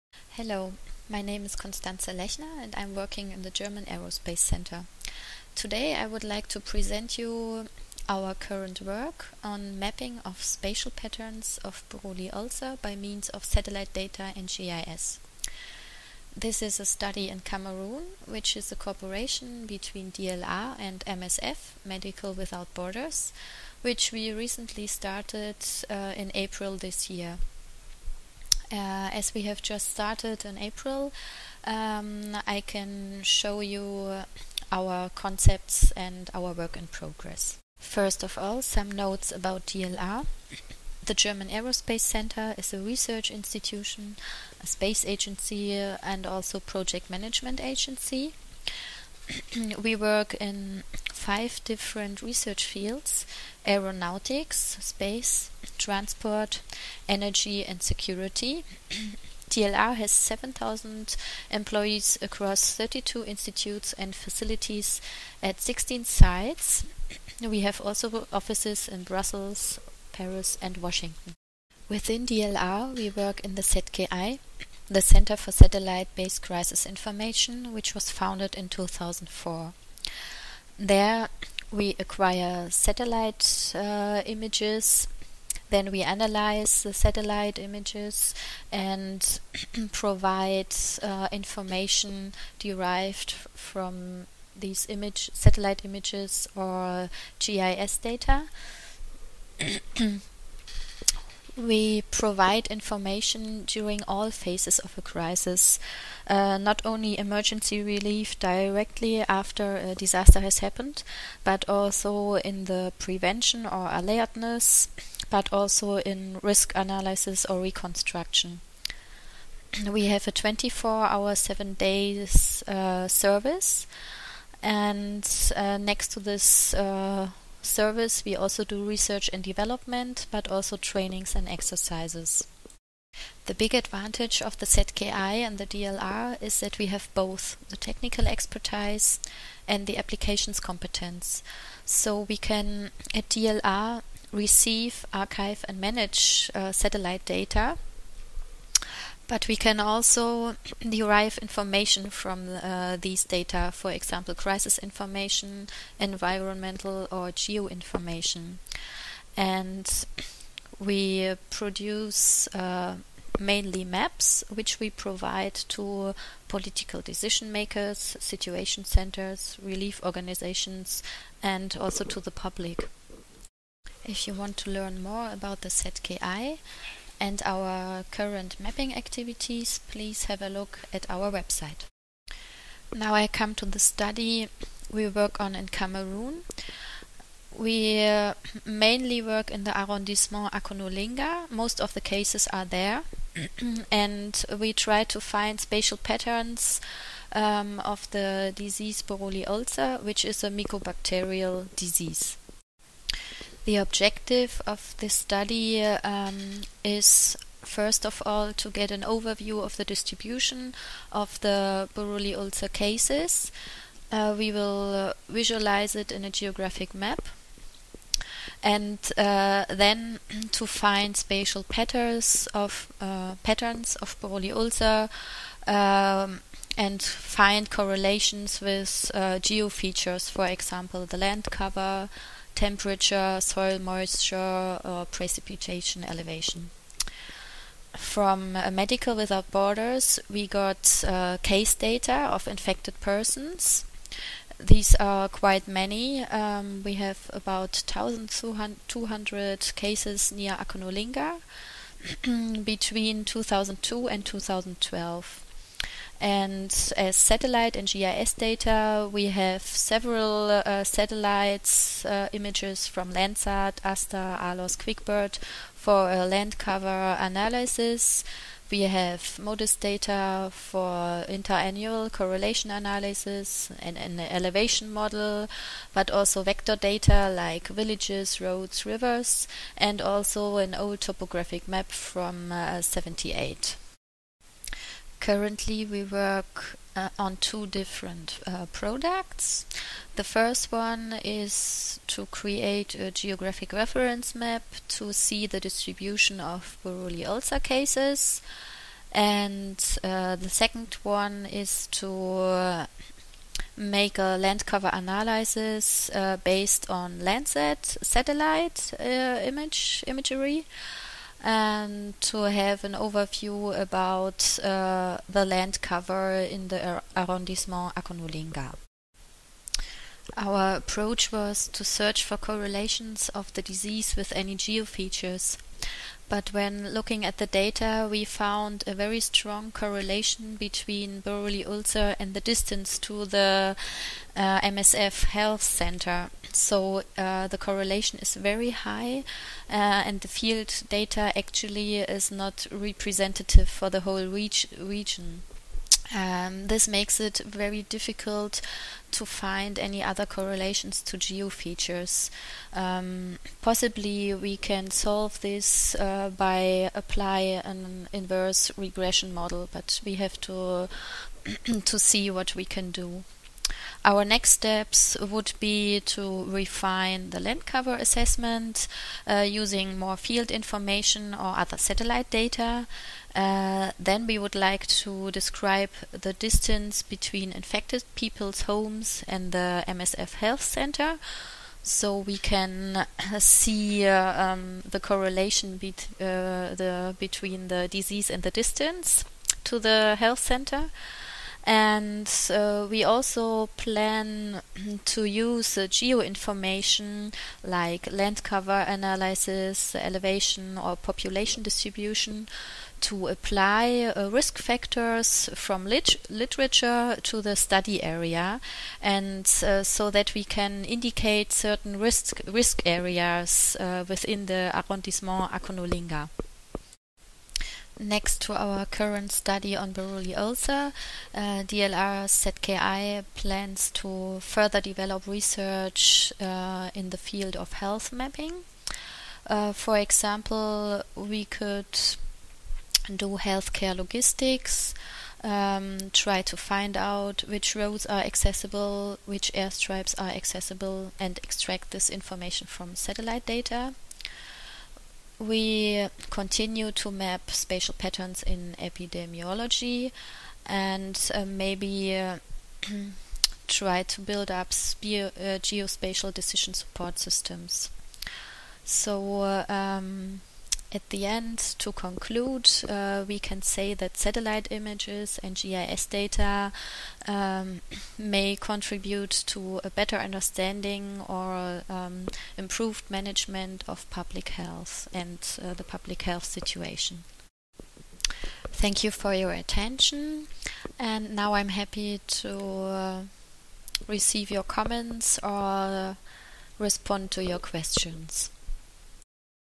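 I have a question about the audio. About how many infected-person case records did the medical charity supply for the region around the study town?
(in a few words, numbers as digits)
1,200.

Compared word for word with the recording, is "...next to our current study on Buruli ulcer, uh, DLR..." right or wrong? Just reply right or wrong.
right.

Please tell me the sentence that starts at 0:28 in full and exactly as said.
Uh, as we have just started in April, um, I can show you our concepts and our work in progress.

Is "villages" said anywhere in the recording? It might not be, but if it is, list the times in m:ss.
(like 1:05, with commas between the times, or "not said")
4:37.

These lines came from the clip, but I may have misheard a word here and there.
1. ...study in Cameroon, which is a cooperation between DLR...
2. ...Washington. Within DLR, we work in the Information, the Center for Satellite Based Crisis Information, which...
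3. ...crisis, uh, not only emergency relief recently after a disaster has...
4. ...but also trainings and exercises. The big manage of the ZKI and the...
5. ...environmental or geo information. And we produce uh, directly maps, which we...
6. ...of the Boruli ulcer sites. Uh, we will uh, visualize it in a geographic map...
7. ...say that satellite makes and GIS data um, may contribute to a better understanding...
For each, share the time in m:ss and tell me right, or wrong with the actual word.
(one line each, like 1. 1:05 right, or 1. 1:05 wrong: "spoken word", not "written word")
1. 0:16 right
2. 1:10 wrong: "ZKI", not "Information"
3. 1:45 wrong: "directly", not "recently"
4. 2:10 wrong: "advantage", not "manage"
5. 2:35 wrong: "mainly", not "directly"
6. 3:31 wrong: "cases", not "sites"
7. 7:43 wrong: "images", not "makes".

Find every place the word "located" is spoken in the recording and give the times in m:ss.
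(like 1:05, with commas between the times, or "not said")
not said.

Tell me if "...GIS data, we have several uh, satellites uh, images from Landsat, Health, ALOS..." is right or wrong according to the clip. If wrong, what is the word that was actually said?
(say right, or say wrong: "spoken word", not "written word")
wrong: "ASTER", not "Health".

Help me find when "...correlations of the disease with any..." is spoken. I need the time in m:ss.
5:22.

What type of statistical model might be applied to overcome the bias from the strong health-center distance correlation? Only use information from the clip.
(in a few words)
inverse regression model.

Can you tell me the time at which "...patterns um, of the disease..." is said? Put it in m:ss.
3:15.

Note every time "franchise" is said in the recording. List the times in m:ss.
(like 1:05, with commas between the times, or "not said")
not said.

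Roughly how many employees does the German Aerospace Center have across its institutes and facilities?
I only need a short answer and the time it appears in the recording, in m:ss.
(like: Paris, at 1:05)
7,000, at 1:00.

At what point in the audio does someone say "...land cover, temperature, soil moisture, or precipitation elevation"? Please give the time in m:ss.
3:51.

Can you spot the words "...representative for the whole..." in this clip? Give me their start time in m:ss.
5:42.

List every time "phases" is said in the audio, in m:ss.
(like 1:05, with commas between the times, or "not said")
1:44.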